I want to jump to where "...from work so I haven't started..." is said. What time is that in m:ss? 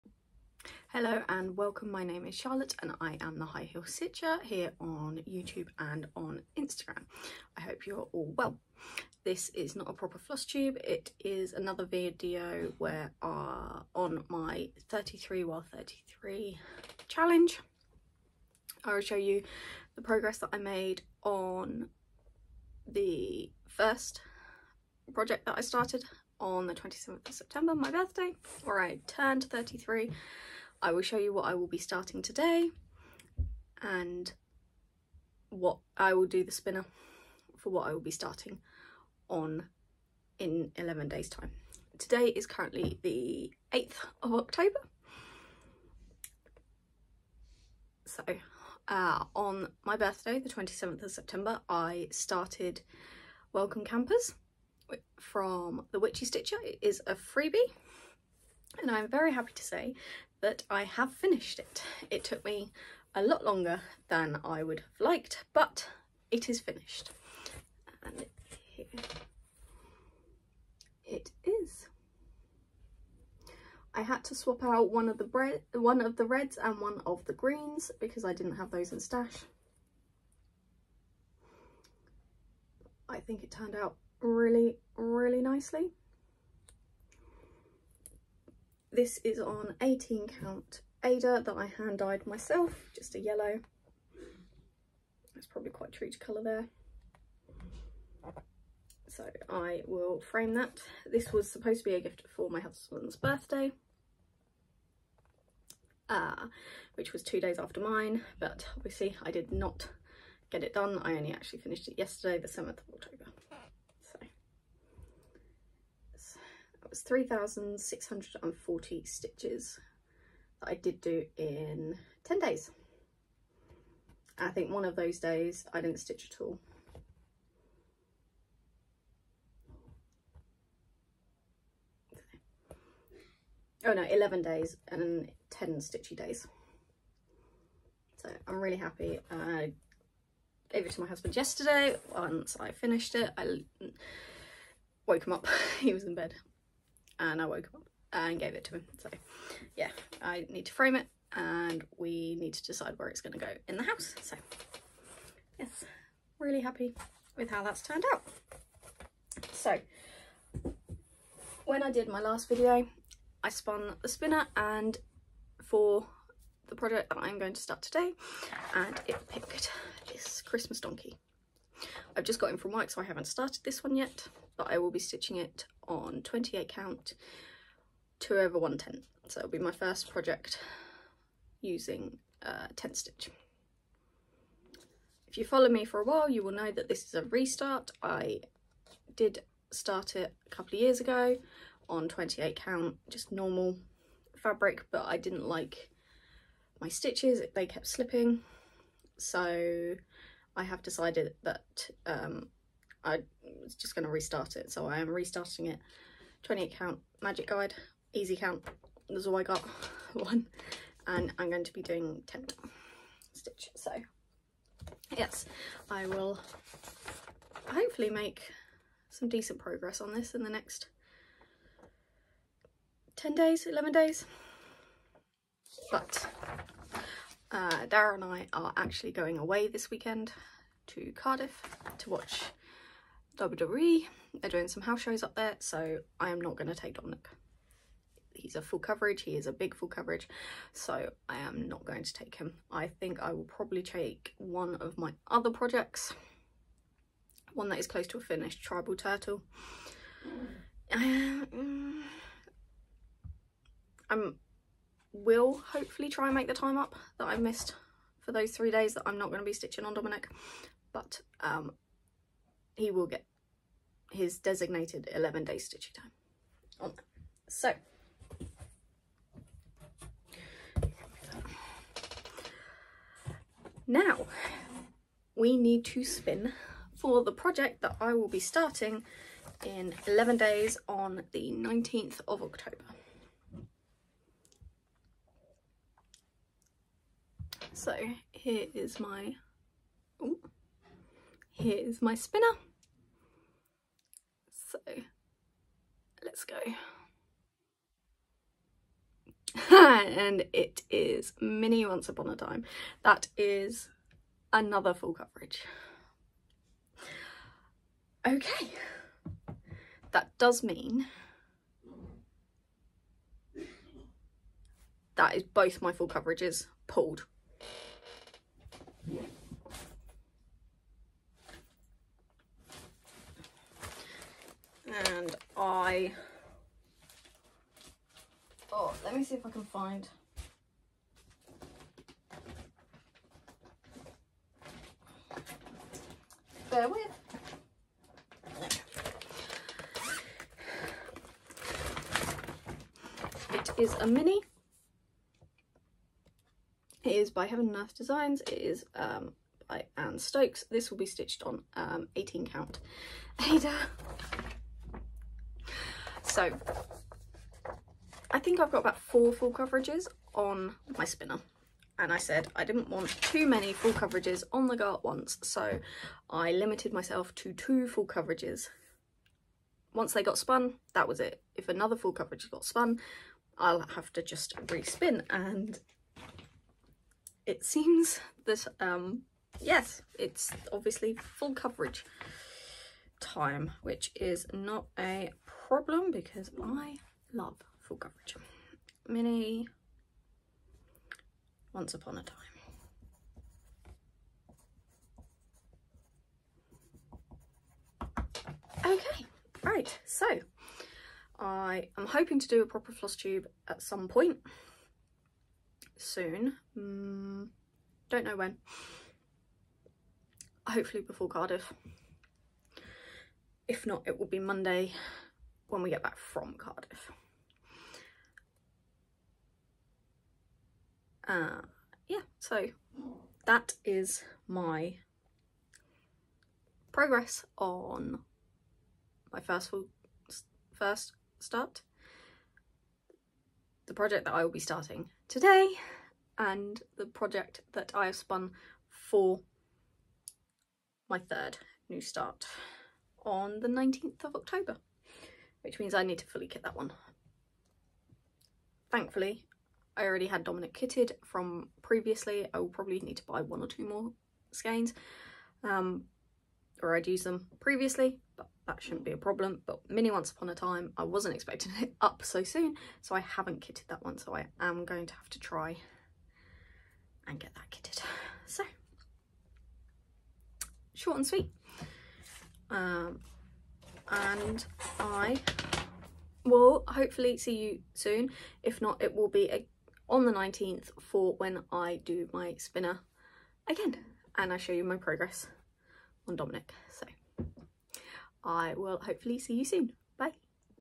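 2:52.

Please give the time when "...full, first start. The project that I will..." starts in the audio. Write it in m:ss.
7:09.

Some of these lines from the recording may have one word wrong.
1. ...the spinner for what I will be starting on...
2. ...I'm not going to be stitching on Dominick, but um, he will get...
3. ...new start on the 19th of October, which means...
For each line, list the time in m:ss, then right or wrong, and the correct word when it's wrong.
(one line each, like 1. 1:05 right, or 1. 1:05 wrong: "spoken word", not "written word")
1. 0:36 right
2. 4:19 right
3. 7:21 right.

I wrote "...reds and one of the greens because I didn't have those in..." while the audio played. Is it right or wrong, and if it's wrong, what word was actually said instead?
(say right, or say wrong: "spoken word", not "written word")
right.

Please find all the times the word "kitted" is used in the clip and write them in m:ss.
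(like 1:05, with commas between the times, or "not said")
7:30, 7:43, 7:47.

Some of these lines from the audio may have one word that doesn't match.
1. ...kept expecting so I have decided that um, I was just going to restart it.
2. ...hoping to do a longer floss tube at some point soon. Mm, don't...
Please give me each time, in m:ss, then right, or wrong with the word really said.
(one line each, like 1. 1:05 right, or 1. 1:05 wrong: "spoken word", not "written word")
1. 3:17 wrong: "slipping", not "expecting"
2. 6:42 wrong: "proper", not "longer".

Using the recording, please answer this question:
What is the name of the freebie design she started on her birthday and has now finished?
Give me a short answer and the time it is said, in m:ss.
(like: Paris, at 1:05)
Welcome Campers, at 0:53.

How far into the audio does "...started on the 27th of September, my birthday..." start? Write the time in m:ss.
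0:25.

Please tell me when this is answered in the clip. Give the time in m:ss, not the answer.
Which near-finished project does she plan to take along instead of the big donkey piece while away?
4:08.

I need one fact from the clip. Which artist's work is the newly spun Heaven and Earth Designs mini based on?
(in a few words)
Anne Stokes.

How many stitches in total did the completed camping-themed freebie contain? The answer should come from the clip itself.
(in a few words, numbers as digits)
3,640.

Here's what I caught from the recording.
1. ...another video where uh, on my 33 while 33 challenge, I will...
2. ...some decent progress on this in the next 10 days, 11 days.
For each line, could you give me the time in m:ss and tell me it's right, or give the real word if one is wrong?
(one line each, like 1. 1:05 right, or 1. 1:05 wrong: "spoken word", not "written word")
1. 0:11 right
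2. 3:39 right.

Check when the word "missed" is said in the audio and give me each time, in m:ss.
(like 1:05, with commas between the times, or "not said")
4:17.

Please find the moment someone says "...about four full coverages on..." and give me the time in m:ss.
5:58.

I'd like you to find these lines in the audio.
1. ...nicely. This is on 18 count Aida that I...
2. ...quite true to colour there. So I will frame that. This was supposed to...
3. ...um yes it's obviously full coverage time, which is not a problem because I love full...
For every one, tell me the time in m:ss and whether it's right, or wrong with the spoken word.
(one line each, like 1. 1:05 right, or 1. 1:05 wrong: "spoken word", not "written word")
1. 1:25 right
2. 1:35 right
3. 6:18 right.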